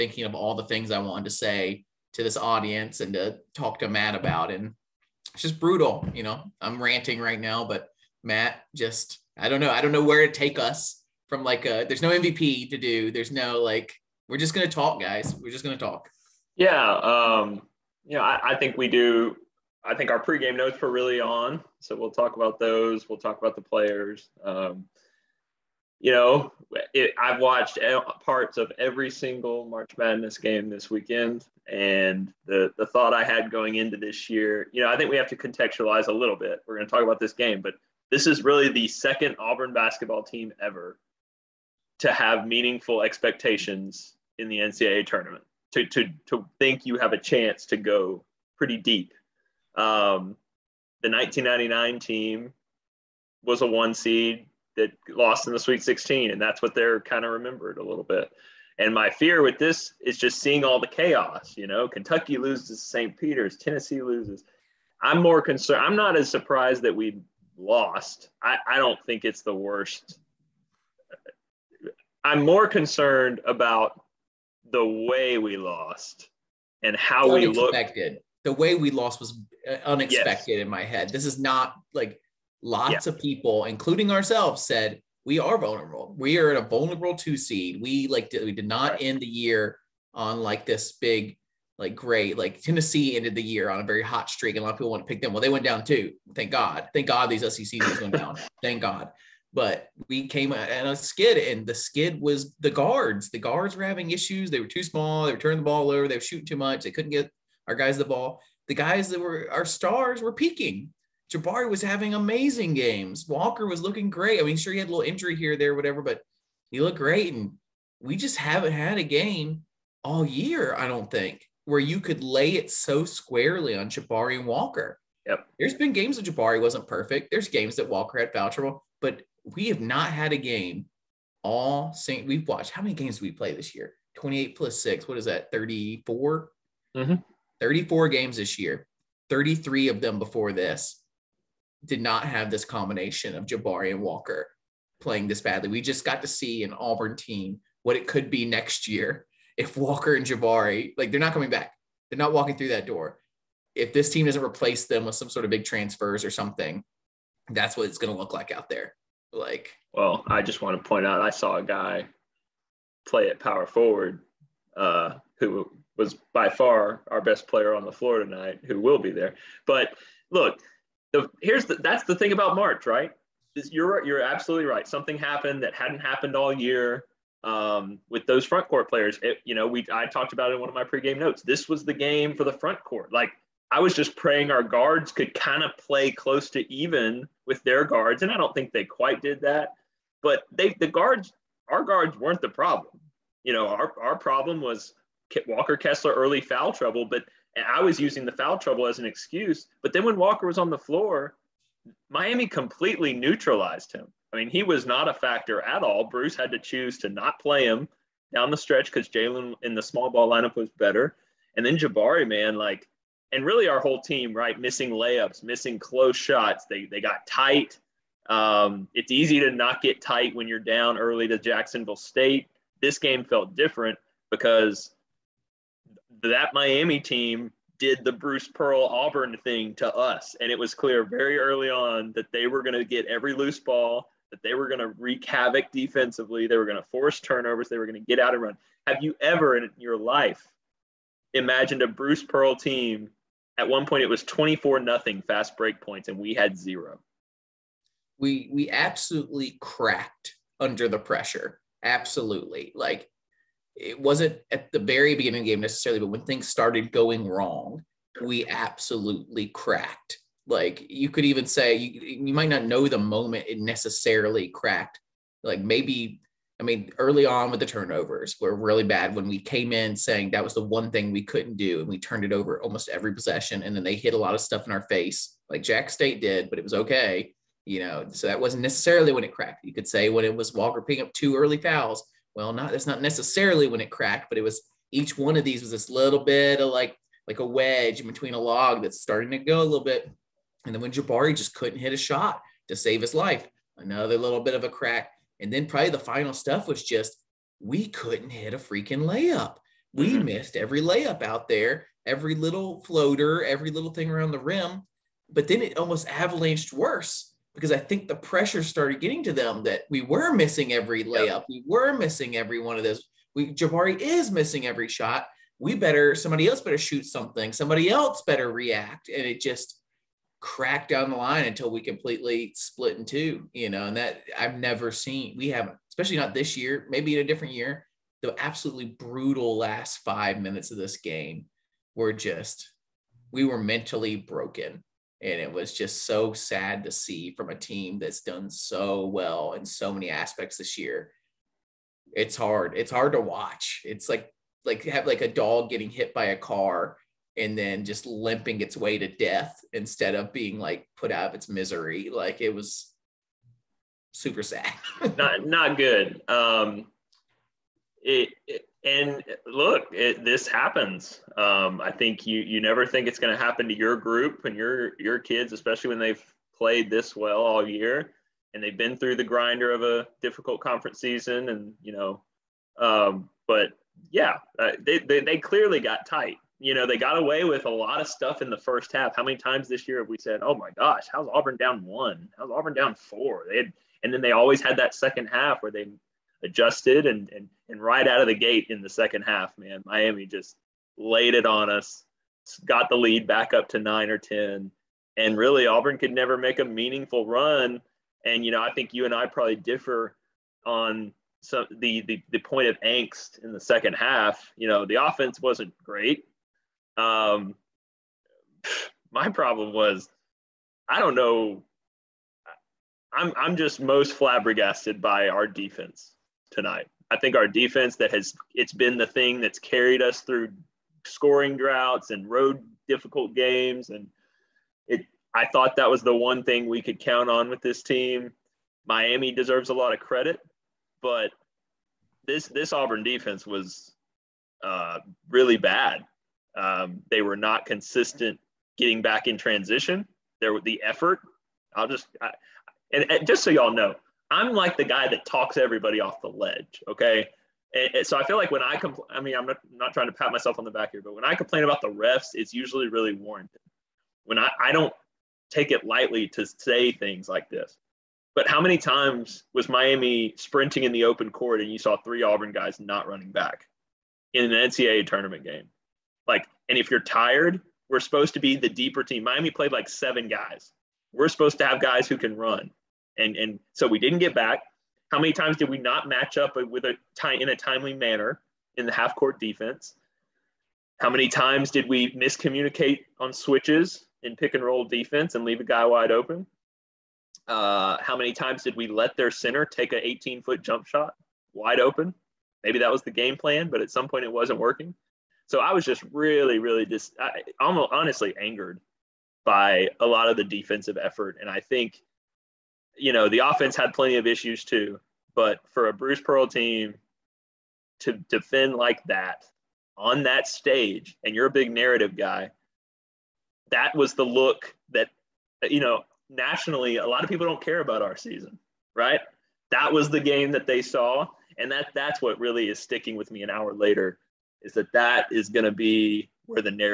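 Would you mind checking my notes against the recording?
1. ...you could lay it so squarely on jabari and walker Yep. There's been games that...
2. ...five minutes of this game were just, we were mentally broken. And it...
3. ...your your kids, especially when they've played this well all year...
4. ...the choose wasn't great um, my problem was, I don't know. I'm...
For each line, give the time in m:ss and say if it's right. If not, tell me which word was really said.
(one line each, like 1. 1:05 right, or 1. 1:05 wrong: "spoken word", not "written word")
1. 2:01 right
2. 5:29 right
3. 6:04 right
4. 6:44 wrong: "offense", not "choose".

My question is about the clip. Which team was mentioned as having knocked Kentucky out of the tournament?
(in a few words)
St. Peter's.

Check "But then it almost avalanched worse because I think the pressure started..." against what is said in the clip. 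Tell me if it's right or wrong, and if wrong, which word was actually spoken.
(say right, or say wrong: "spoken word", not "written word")
right.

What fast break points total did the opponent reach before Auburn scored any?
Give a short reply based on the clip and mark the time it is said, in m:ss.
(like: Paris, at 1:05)
24, at 4:04.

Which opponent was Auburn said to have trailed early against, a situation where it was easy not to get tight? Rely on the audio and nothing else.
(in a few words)
Jacksonville State.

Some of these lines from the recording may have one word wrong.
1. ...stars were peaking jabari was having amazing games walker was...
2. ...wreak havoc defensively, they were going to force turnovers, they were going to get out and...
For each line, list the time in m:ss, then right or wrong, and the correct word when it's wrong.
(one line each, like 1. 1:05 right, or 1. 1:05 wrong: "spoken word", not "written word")
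1. 1:49 right
2. 3:54 right.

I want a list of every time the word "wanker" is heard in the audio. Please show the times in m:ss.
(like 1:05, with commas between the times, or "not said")
not said.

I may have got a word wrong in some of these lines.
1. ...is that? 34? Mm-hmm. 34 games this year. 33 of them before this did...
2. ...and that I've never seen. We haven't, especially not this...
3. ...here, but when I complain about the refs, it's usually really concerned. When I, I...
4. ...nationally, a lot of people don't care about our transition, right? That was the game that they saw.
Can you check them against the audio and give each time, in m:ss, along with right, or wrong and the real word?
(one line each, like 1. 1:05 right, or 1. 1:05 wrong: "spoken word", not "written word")
1. 2:15 right
2. 5:23 right
3. 7:30 wrong: "warranted", not "concerned"
4. 8:36 wrong: "season", not "transition".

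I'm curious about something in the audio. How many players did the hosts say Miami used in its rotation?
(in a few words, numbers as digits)
7.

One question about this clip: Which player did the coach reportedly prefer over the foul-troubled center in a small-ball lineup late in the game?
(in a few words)
Jalen.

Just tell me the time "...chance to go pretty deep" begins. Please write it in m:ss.
0:47.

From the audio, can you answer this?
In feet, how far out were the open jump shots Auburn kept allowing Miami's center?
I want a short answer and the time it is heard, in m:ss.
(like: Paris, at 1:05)
18, at 8:10.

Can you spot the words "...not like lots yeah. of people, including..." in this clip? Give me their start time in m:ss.
1:21.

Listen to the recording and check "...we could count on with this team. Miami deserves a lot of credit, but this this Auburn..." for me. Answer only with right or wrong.
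right.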